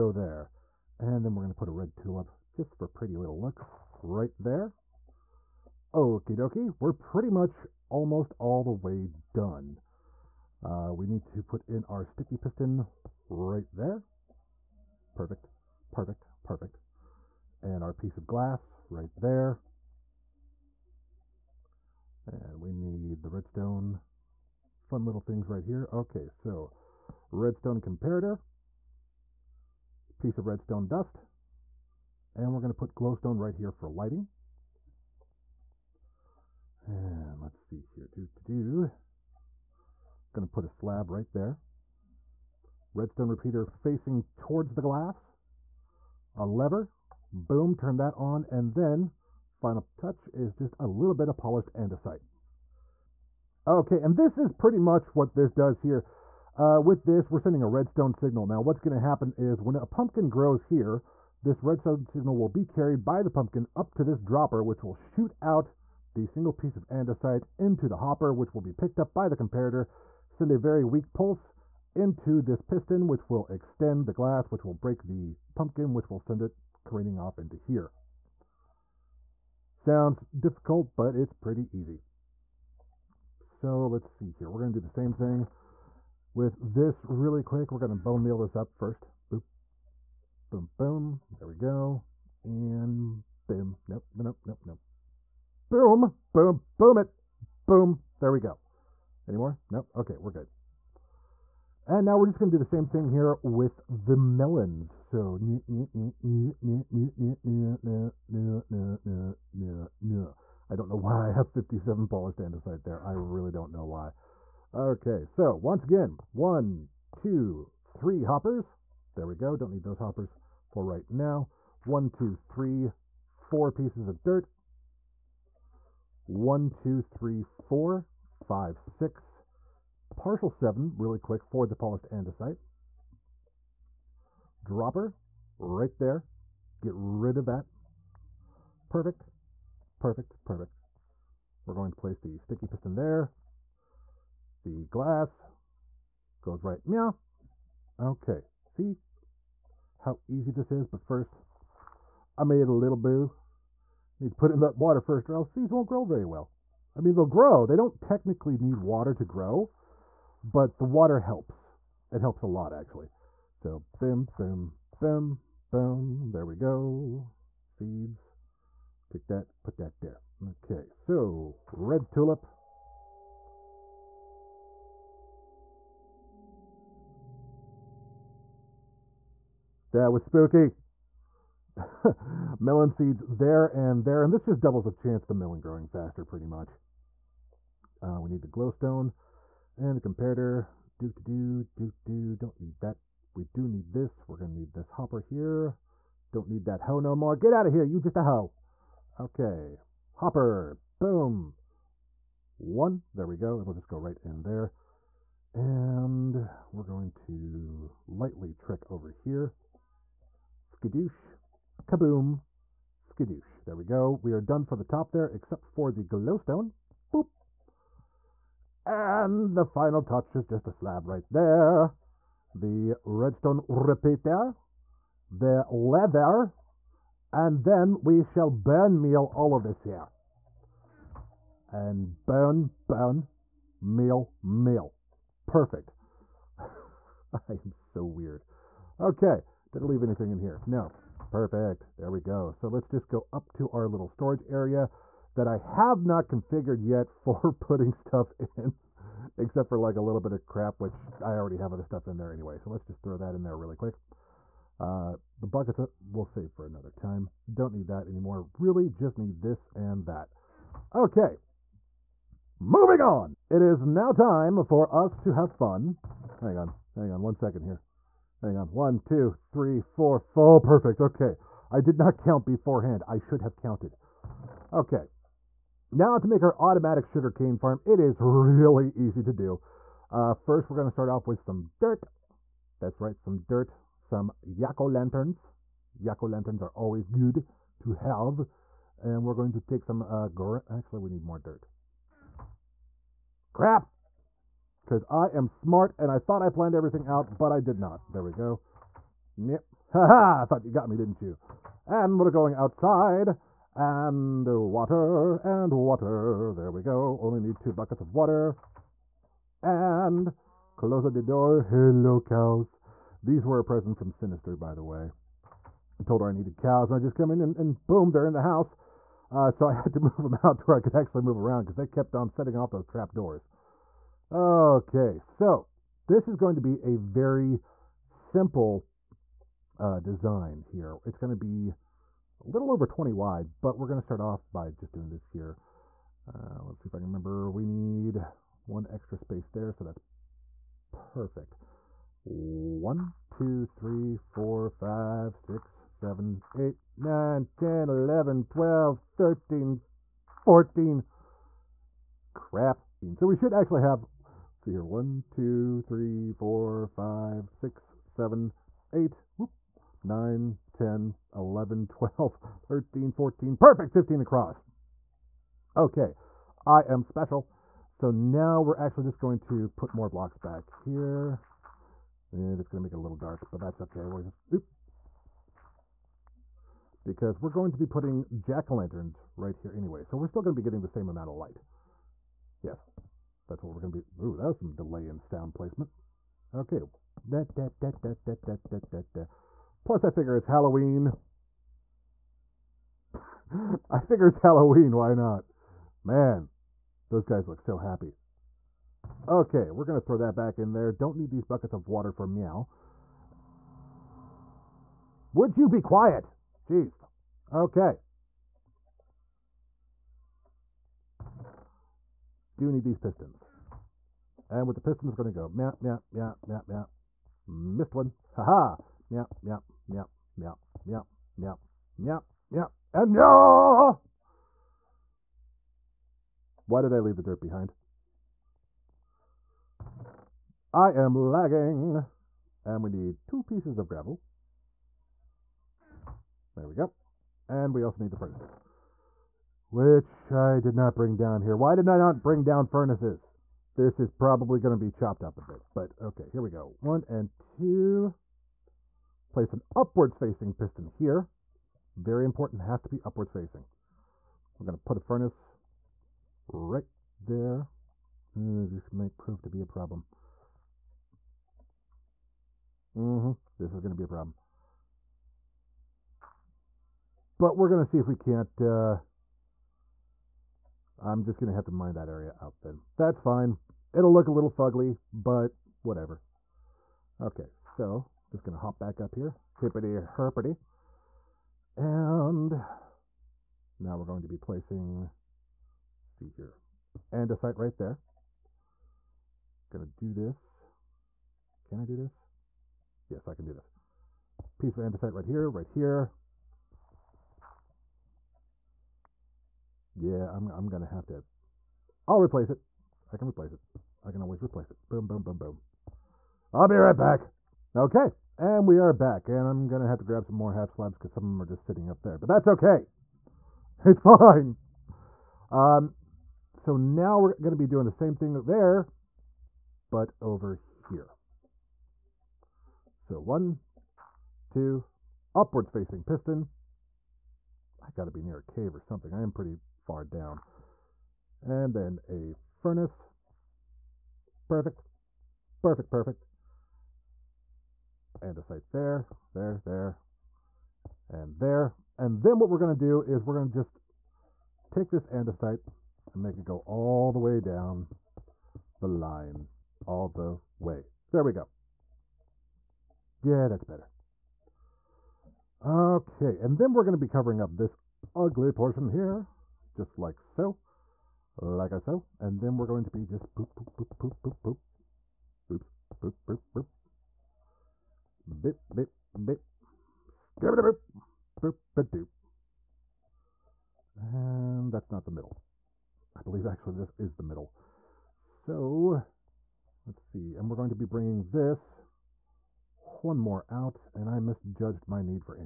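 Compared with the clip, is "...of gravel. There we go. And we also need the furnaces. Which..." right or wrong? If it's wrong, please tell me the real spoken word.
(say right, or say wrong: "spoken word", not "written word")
right.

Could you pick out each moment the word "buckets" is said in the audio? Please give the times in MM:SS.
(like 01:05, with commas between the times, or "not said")
04:15, 05:07, 06:41.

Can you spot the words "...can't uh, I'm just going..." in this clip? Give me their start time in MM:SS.
07:48.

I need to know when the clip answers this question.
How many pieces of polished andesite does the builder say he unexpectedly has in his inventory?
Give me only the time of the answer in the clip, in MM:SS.
01:51.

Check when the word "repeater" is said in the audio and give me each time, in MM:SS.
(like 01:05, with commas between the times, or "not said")
00:43, 03:43.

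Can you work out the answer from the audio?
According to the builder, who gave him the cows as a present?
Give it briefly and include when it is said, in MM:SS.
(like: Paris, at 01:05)
Sinister, at 05:14.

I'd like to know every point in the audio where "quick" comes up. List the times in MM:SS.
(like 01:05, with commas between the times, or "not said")
01:27, 02:11, 04:13.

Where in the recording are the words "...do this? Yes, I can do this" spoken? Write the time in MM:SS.
08:11.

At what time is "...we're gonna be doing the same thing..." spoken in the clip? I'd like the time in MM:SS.
08:37.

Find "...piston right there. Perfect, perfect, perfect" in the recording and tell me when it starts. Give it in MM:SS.
00:12.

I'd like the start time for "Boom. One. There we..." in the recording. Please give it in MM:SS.
03:20.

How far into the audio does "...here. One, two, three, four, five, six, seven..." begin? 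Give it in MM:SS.
05:54.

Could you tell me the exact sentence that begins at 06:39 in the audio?
Okay, we're going to throw that back in there.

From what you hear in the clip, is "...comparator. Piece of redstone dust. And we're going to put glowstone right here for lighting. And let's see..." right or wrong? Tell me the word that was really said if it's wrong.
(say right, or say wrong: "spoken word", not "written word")
right.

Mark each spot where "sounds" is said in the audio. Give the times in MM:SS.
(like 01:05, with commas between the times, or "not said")
01:19, 06:25.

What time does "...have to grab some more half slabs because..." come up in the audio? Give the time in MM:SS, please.
08:29.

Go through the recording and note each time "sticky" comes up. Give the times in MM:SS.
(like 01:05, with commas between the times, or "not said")
00:12, 02:22.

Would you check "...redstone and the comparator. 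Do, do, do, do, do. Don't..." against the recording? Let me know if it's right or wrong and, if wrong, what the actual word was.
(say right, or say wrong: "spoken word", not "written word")
wrong: "glowstone", not "redstone".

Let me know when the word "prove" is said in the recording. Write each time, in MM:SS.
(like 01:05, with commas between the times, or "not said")
07:39.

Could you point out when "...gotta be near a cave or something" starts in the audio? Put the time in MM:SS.
08:47.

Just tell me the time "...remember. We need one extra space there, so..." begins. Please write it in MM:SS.
05:37.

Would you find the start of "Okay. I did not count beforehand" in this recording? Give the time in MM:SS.
04:31.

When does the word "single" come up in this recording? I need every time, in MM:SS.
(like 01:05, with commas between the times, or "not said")
01:06.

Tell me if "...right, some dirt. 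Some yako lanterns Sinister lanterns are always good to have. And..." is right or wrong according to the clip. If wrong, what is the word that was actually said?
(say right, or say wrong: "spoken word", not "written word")
wrong: "Yako", not "Sinister".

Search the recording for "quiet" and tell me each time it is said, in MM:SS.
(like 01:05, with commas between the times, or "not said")
06:45.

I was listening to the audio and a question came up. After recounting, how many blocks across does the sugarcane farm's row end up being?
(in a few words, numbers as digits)
15.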